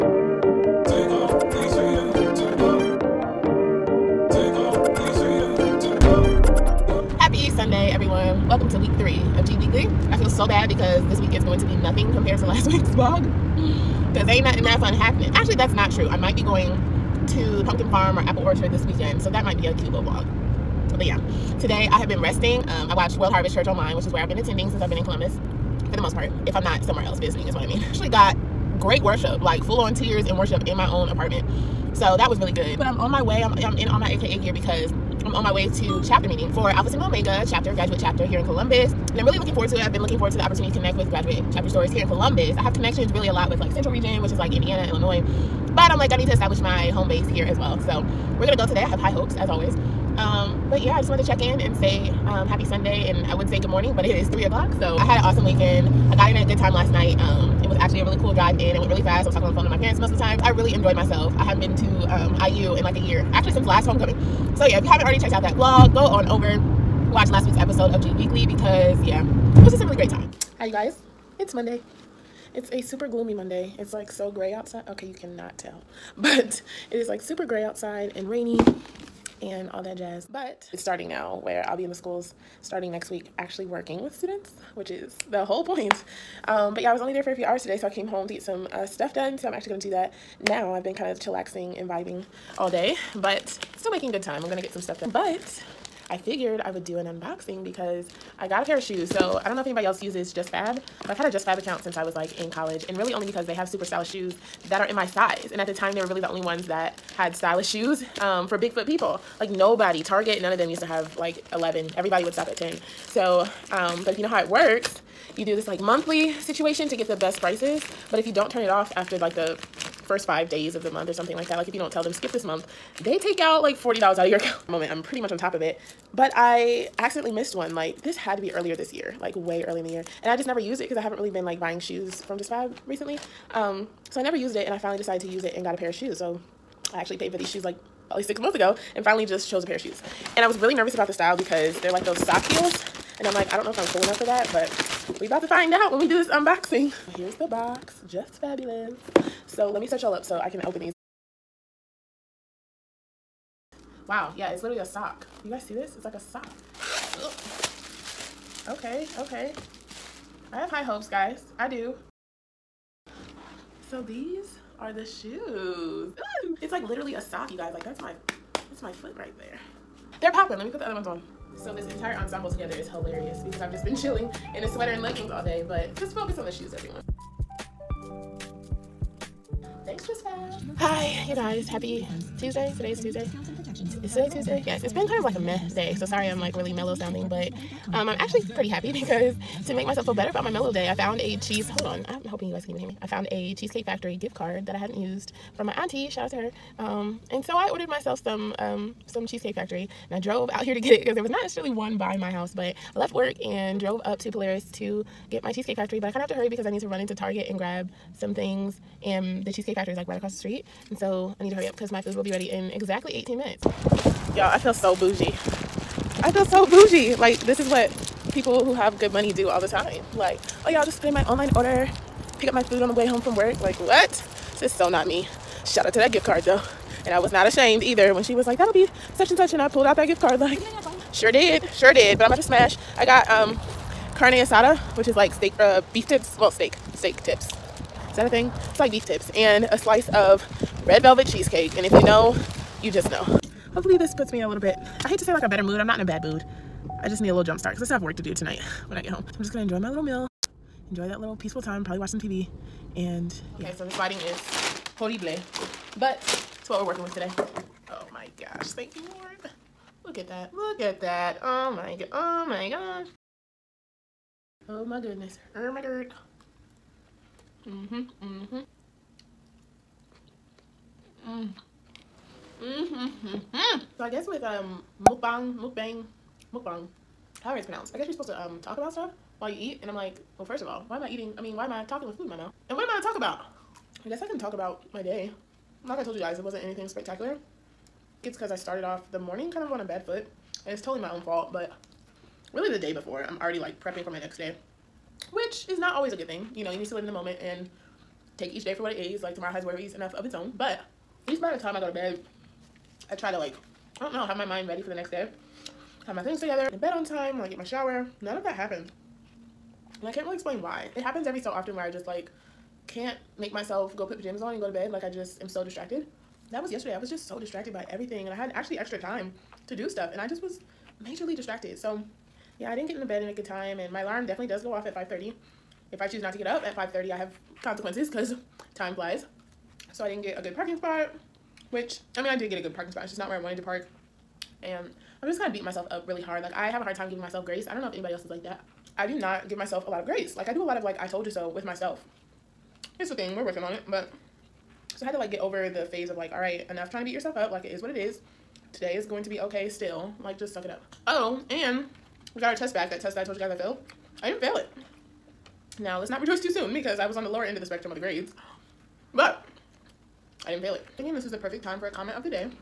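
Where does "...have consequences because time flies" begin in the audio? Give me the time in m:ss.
5:27.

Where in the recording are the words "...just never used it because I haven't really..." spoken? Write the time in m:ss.
2:10.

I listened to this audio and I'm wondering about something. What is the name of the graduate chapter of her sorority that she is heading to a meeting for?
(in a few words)
Alpha Sigma Omega.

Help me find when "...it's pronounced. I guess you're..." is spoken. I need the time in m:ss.
4:37.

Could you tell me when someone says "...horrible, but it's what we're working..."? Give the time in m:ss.
4:14.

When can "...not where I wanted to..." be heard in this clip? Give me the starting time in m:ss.
5:33.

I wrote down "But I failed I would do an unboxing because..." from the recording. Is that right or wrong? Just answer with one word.
wrong.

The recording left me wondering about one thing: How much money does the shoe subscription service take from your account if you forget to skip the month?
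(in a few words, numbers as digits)
$40.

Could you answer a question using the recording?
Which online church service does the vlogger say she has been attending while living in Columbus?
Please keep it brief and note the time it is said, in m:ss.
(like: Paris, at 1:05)
World Harvest Church, at 0:23.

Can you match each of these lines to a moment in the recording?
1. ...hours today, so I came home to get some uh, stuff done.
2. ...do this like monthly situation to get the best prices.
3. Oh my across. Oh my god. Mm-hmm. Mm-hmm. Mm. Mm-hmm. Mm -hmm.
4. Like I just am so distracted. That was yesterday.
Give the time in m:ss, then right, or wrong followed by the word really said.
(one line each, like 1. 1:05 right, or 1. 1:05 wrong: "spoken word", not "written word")
1. 1:27 right
2. 1:55 right
3. 4:24 wrong: "goodness", not "across"
4. 5:14 right.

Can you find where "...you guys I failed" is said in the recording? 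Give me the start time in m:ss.
5:53.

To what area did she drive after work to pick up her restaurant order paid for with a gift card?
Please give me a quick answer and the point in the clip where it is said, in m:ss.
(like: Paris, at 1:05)
Polaris, at 3:24.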